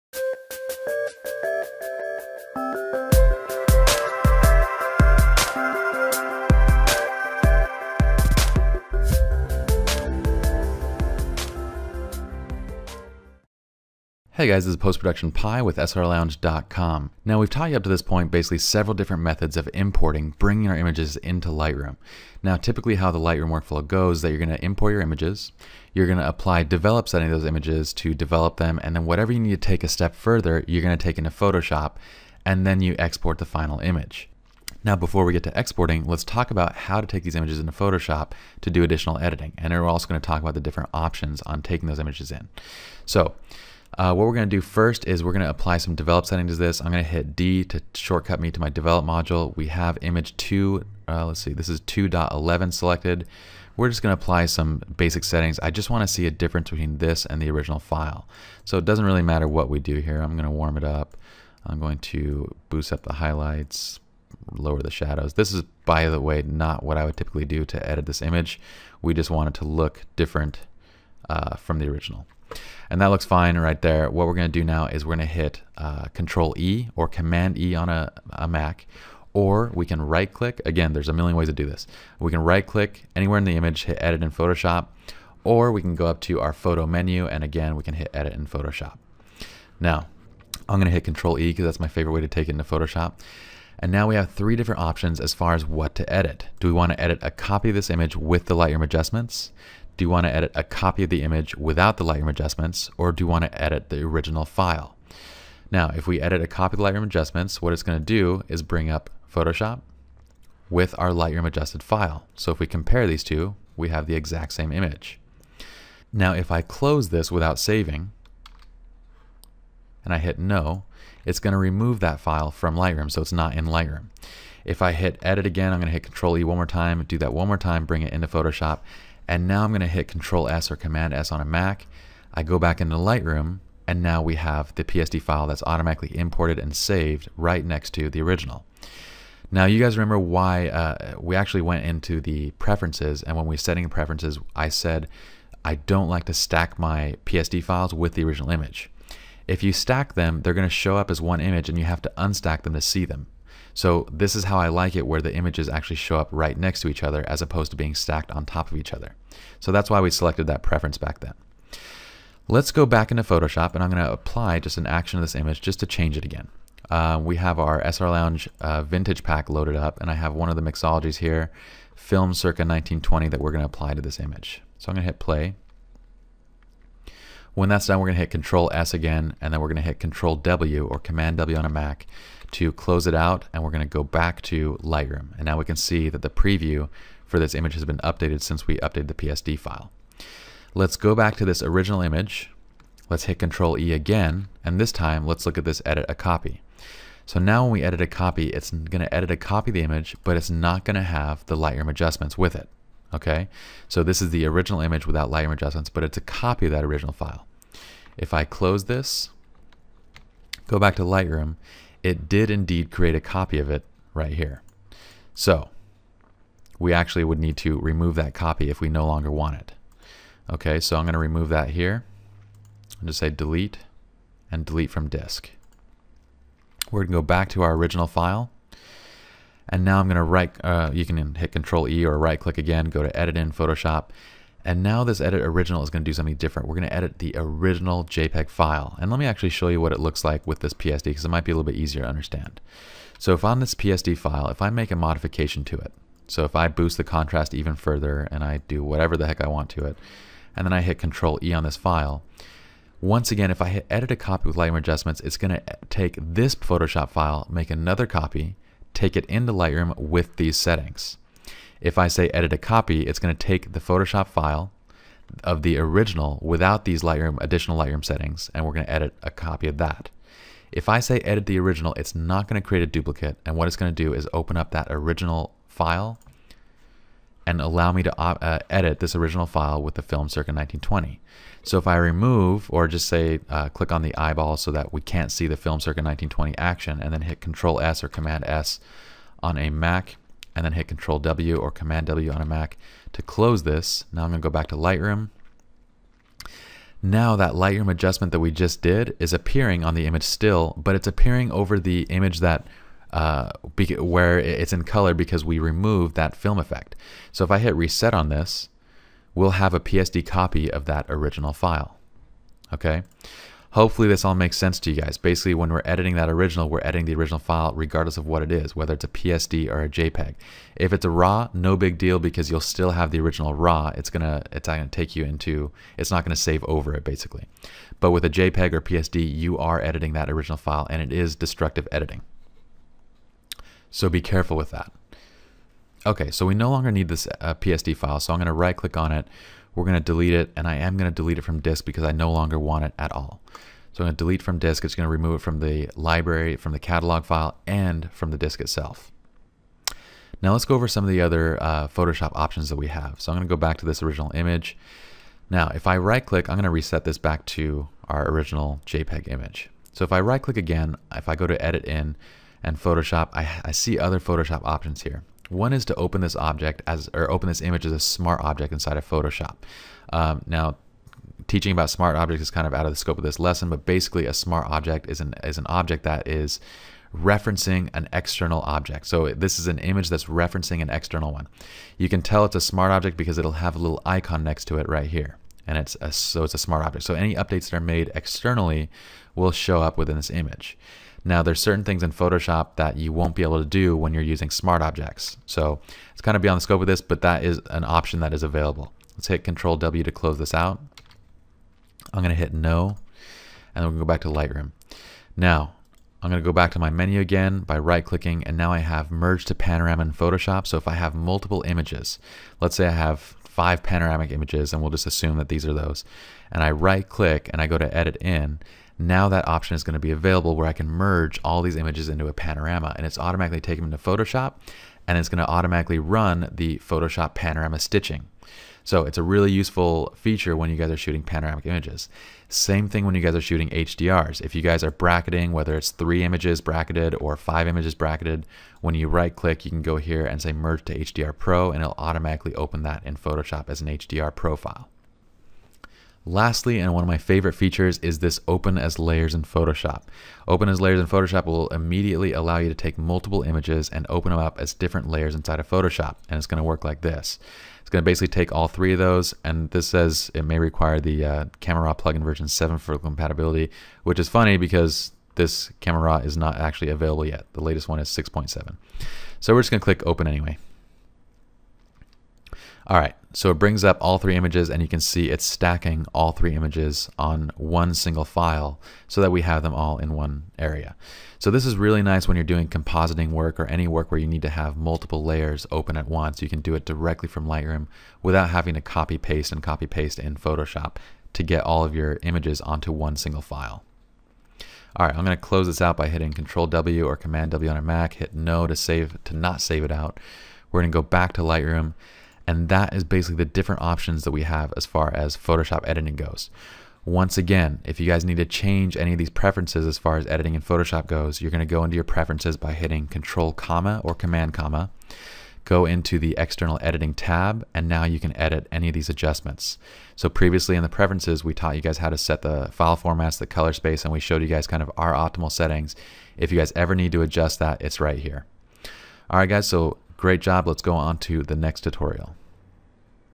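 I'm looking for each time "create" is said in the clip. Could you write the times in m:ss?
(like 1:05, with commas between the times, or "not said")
3:32, 4:32.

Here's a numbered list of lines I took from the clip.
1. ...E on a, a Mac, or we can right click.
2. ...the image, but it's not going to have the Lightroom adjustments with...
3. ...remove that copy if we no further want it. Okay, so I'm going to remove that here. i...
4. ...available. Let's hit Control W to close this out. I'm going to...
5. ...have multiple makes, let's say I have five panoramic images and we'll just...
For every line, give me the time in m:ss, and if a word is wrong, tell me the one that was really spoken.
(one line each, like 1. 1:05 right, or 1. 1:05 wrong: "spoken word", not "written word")
1. 1:17 right
2. 3:19 right
3. 3:37 wrong: "longer", not "further"
4. 6:38 right
5. 6:50 wrong: "images", not "makes".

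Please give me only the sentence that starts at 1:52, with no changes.
So if we compare these two, we have the exact same image.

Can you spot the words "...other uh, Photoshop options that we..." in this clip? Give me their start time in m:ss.
5:51.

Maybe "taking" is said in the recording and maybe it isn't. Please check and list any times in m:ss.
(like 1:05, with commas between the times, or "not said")
0:41, 7:03.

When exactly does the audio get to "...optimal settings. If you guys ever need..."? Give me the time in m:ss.
8:45.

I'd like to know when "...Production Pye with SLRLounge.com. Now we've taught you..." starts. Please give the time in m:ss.
0:14.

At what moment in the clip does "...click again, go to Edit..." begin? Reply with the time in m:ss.
3:52.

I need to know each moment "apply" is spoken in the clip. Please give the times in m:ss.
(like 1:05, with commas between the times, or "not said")
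0:26, 0:45, 0:54, 2:44, 2:53.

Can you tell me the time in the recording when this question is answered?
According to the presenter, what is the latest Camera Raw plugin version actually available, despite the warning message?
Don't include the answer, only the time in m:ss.
7:48.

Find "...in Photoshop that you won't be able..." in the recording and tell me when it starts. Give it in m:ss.
6:32.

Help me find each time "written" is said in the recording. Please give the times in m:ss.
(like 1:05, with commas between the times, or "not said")
not said.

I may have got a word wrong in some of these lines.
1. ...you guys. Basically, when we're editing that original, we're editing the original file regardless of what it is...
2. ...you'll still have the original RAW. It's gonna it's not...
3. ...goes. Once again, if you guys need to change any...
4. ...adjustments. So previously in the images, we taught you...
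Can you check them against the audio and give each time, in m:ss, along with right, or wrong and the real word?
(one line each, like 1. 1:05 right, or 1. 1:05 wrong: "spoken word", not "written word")
1. 5:14 right
2. 5:22 right
3. 8:26 right
4. 8:39 wrong: "preferences", not "images".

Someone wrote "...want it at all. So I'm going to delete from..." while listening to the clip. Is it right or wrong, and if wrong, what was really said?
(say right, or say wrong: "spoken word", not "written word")
right.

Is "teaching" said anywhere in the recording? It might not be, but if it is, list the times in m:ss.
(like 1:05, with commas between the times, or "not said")
6:11.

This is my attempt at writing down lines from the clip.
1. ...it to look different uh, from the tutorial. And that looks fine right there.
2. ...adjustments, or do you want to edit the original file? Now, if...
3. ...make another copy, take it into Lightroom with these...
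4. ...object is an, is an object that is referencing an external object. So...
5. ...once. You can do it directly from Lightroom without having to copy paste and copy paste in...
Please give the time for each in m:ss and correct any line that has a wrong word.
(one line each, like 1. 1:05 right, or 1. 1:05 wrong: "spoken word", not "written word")
1. 1:09 wrong: "original", not "tutorial"
2. 1:42 right
3. 4:17 right
4. 6:14 right
5. 8:06 right.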